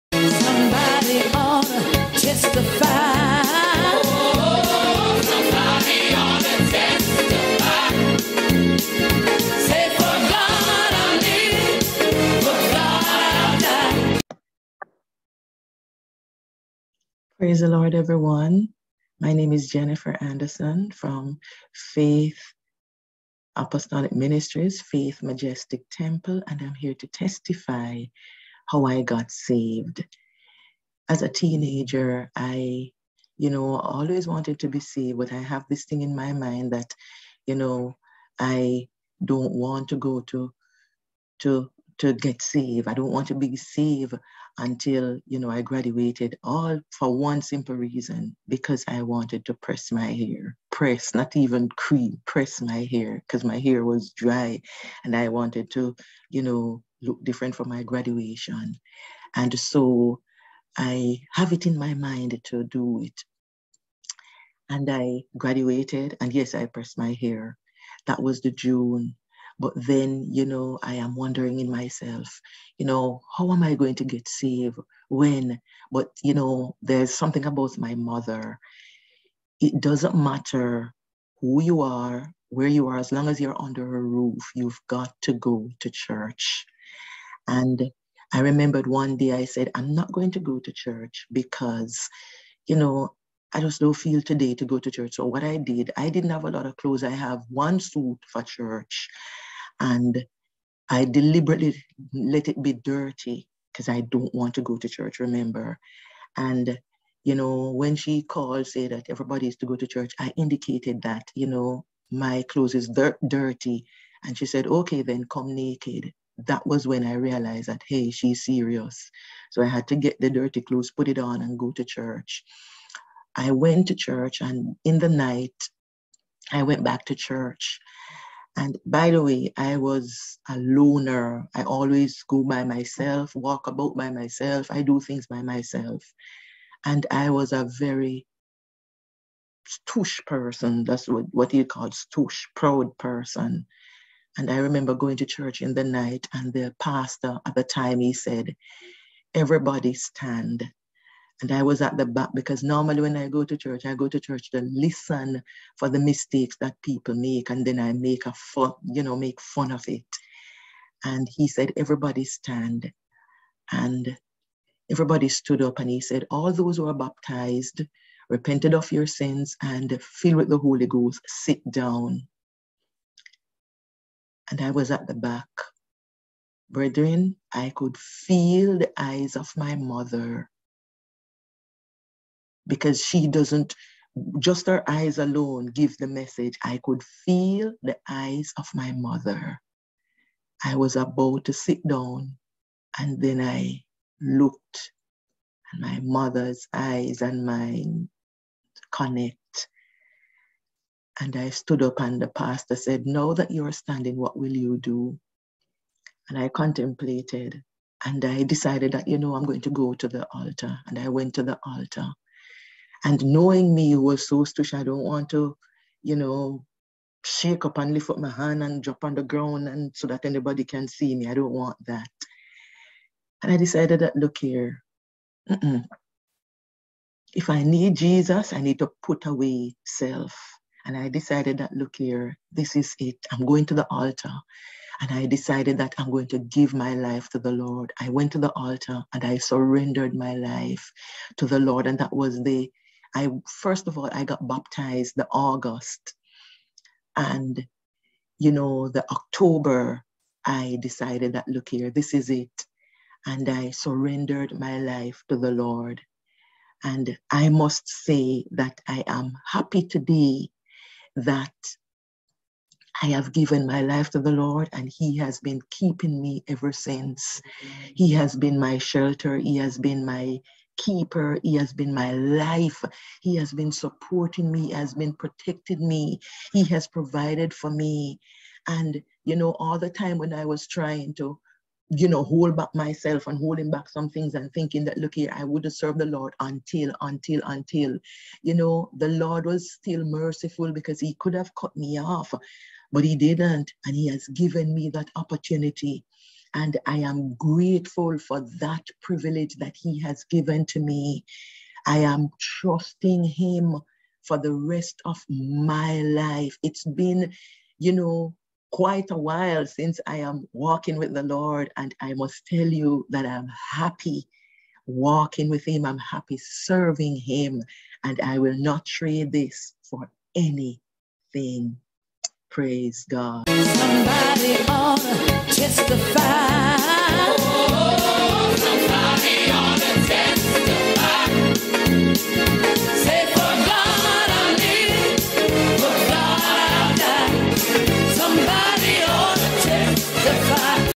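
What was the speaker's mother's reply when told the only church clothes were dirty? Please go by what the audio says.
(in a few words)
Come naked.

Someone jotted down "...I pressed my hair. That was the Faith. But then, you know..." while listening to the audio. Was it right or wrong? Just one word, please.
wrong.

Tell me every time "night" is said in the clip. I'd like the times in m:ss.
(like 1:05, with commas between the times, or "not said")
2:05, 2:25.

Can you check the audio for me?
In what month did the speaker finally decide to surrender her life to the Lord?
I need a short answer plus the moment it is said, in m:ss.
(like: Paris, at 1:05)
October, at 4:09.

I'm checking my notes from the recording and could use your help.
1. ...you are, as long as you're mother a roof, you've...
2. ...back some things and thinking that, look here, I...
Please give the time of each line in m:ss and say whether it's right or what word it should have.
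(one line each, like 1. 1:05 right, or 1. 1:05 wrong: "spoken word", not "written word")
1. 1:22 wrong: "under", not "mother"
2. 4:43 right.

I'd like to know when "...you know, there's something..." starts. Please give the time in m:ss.
1:16.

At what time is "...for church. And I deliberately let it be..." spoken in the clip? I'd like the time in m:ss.
1:38.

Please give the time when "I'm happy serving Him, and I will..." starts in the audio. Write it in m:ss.
5:15.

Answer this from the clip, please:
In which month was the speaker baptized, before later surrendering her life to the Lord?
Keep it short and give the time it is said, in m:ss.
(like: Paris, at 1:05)
August, at 4:05.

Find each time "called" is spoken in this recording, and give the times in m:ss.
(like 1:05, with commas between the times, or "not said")
1:48, 2:21.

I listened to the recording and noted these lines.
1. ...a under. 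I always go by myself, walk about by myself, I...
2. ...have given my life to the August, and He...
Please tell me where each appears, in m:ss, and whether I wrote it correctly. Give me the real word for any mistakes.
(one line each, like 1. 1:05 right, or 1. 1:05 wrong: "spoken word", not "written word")
1. 2:10 wrong: "loner", not "under"
2. 4:23 wrong: "Lord", not "August".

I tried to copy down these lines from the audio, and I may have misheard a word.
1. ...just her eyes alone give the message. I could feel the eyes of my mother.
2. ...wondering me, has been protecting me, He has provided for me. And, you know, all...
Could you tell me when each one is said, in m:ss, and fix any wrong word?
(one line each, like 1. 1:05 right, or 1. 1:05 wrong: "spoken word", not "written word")
1. 3:04 right
2. 4:33 wrong: "supporting", not "wondering".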